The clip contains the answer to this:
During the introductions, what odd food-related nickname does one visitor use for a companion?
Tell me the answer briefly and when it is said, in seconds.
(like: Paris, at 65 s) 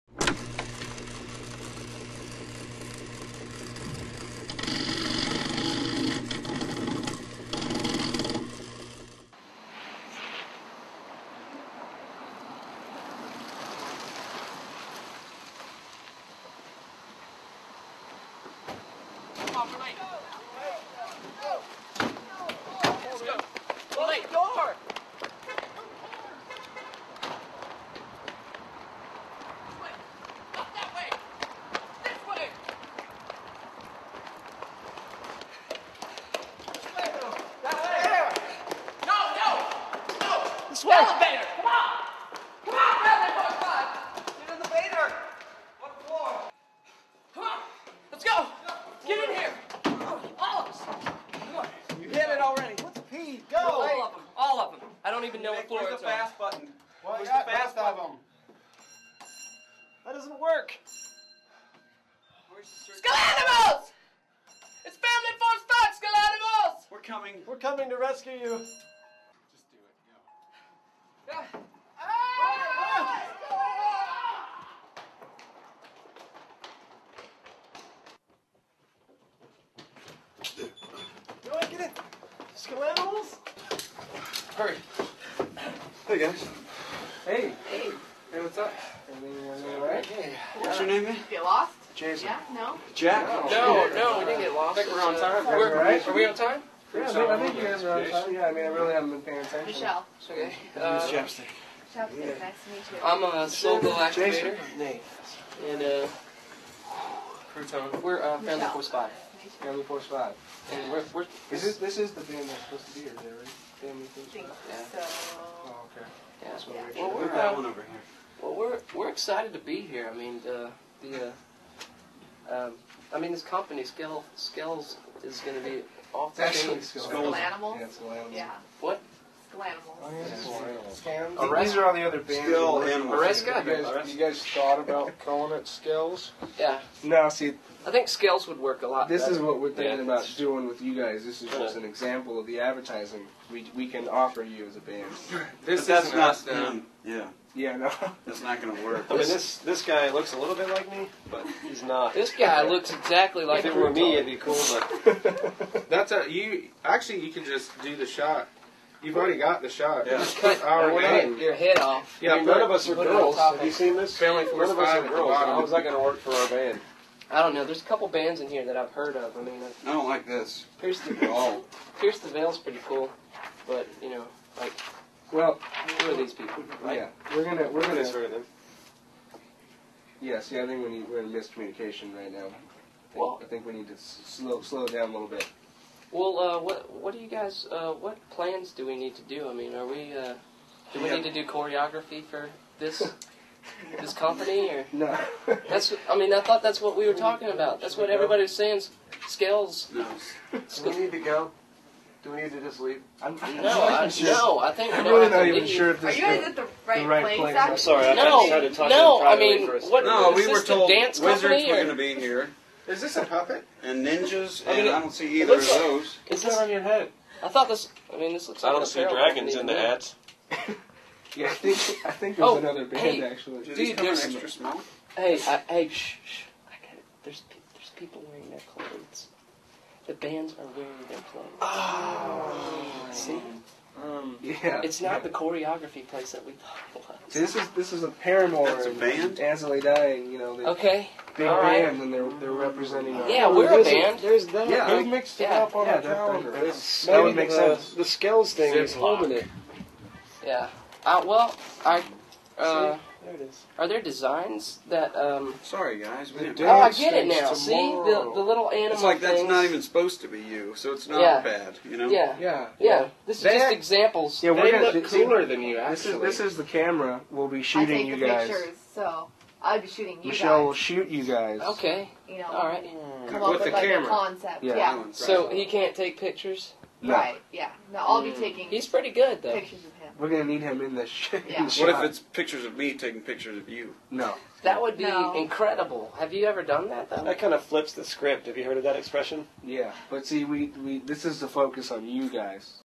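Crouton, at 107 s.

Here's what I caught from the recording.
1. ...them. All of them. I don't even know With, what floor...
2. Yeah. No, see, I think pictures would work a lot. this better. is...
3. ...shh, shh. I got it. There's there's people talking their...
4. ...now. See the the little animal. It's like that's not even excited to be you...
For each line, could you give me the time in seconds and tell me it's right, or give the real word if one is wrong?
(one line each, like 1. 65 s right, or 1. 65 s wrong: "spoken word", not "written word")
1. 54 s wrong: "Nick", not "With"
2. 136 s wrong: "scales", not "pictures"
3. 225 s wrong: "wearing", not "talking"
4. 257 s wrong: "supposed", not "excited".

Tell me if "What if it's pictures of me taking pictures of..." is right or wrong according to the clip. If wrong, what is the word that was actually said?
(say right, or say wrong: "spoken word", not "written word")
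right.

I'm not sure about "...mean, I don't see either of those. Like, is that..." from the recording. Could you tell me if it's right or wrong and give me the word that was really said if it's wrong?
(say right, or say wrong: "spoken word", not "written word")
right.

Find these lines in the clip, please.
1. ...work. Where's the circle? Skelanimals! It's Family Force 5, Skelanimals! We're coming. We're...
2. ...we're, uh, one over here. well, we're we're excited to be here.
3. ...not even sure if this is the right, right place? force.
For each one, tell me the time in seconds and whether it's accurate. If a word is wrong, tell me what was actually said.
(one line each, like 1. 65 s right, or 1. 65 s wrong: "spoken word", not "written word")
1. 60 s right
2. 117 s right
3. 205 s wrong: "place", not "force".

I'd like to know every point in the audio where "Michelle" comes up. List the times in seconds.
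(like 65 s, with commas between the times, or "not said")
99 s, 270 s.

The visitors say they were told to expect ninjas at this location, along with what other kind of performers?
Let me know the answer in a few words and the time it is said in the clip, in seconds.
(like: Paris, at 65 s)
dance wizards, at 210 s.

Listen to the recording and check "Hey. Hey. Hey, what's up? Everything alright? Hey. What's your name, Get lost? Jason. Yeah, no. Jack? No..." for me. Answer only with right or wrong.
right.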